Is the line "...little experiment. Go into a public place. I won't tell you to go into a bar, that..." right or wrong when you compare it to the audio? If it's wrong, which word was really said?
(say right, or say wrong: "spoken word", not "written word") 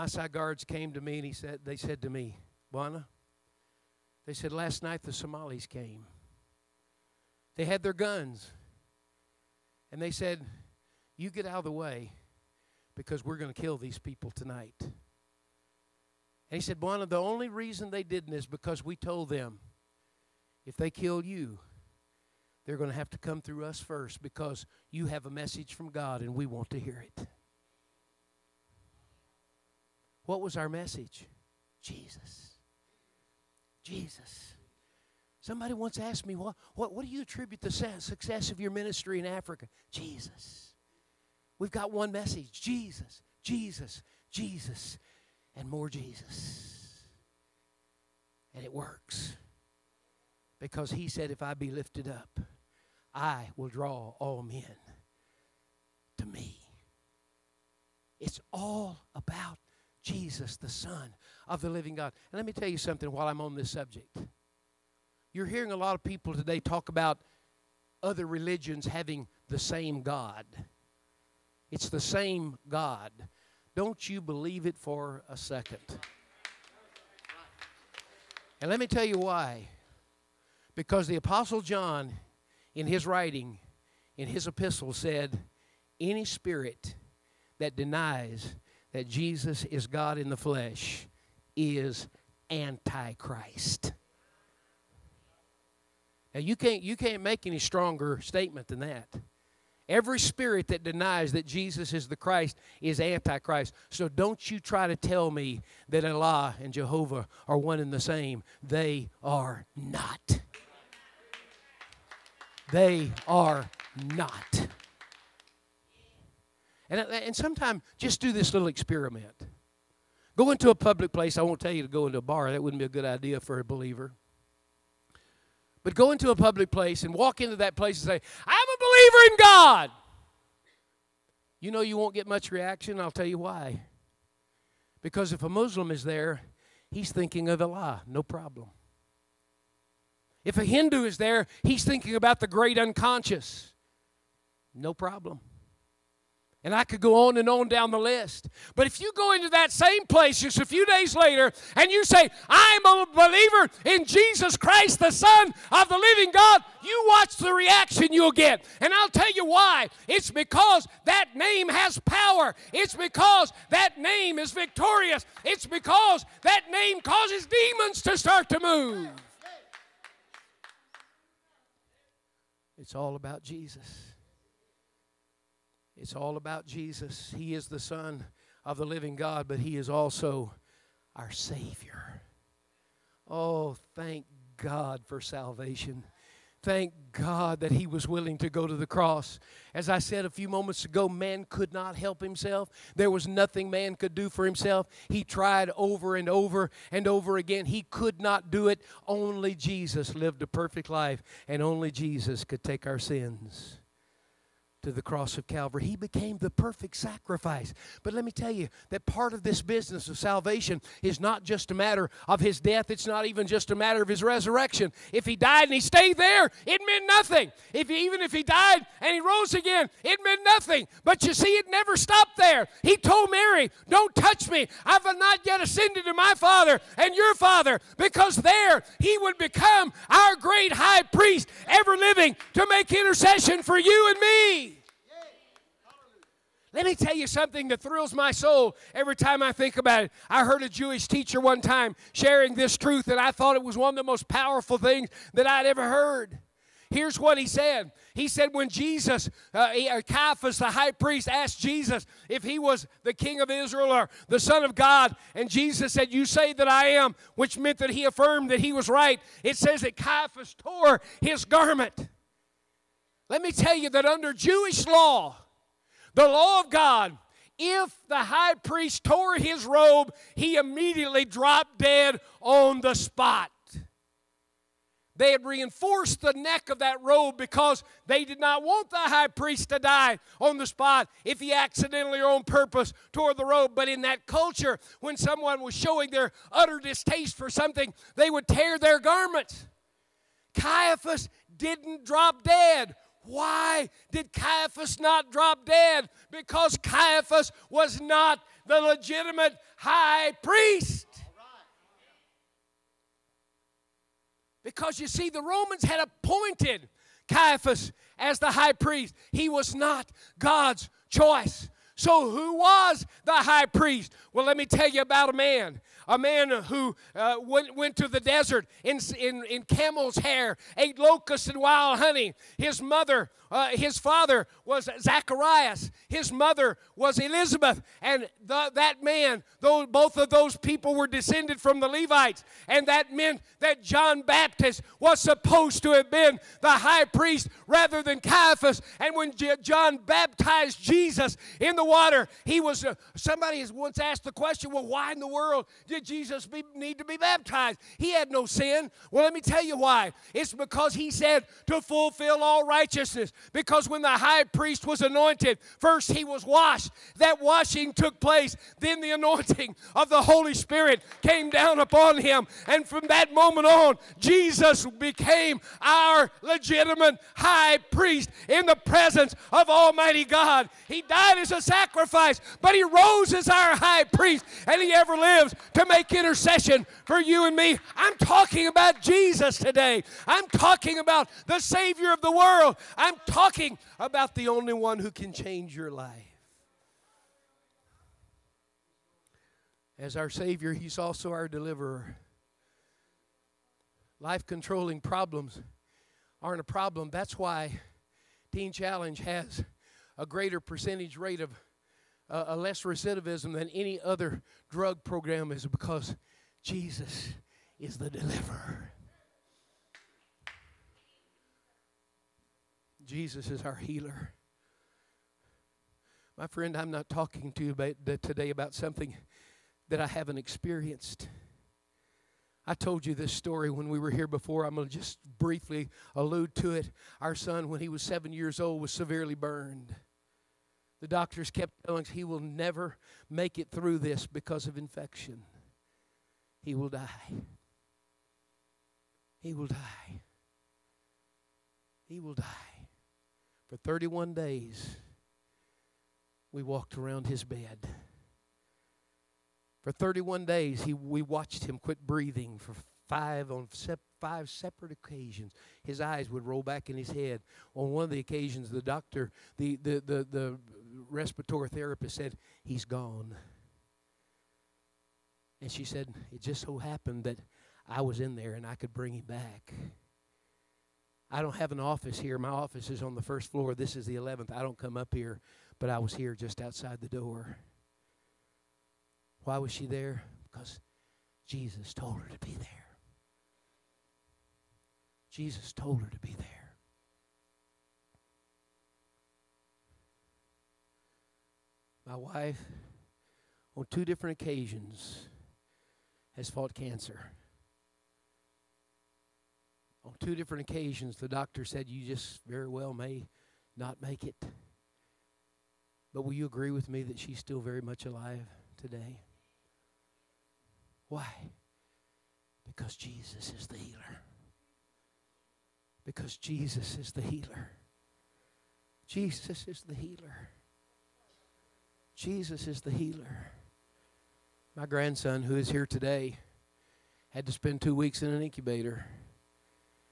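right.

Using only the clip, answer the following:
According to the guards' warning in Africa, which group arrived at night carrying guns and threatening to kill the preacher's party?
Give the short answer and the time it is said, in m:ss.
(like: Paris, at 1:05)
Somalis, at 0:05.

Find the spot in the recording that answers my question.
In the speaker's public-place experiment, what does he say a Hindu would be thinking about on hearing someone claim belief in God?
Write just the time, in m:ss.
2:22.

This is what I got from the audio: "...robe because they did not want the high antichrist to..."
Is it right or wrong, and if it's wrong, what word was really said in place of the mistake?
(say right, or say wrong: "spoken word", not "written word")
wrong: "priest", not "antichrist".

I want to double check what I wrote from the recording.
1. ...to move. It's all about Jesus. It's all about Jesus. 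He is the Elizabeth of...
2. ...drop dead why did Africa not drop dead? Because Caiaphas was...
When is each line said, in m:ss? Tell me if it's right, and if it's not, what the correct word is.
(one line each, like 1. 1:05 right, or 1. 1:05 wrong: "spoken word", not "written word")
1. 2:48 wrong: "Son", not "Elizabeth"
2. 4:52 wrong: "Caiaphas", not "Africa".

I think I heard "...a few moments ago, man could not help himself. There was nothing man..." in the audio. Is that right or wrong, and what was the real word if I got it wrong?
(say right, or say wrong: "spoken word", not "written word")
right.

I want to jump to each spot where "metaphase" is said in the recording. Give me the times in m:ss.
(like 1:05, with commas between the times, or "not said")
not said.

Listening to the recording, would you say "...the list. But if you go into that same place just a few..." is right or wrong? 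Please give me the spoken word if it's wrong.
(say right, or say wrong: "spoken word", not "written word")
right.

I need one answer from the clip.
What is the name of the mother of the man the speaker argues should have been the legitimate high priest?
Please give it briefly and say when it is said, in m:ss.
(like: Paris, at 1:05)
Elizabeth, at 5:27.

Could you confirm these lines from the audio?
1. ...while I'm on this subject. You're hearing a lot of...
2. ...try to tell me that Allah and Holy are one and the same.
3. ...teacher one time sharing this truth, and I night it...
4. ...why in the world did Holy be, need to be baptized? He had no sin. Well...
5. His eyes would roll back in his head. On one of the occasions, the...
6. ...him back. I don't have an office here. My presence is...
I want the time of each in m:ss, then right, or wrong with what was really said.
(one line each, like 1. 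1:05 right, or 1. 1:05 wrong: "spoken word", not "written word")
1. 1:03 right
2. 1:44 wrong: "Jehovah", not "Holy"
3. 4:01 wrong: "thought", not "night"
4. 5:44 wrong: "Jesus", not "Holy"
5. 7:35 right
6. 7:49 wrong: "office", not "presence".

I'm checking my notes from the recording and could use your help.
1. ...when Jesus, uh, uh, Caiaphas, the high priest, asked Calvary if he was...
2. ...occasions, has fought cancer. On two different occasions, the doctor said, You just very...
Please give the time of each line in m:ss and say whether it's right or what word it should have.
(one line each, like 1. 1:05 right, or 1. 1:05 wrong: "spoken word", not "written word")
1. 4:08 wrong: "Jesus", not "Calvary"
2. 8:14 right.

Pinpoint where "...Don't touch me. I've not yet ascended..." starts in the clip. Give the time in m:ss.
3:43.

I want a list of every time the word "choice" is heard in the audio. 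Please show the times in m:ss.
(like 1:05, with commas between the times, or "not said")
5:11.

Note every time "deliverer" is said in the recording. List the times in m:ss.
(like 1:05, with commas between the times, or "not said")
6:31, 6:48.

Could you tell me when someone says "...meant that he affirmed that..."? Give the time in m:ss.
4:17.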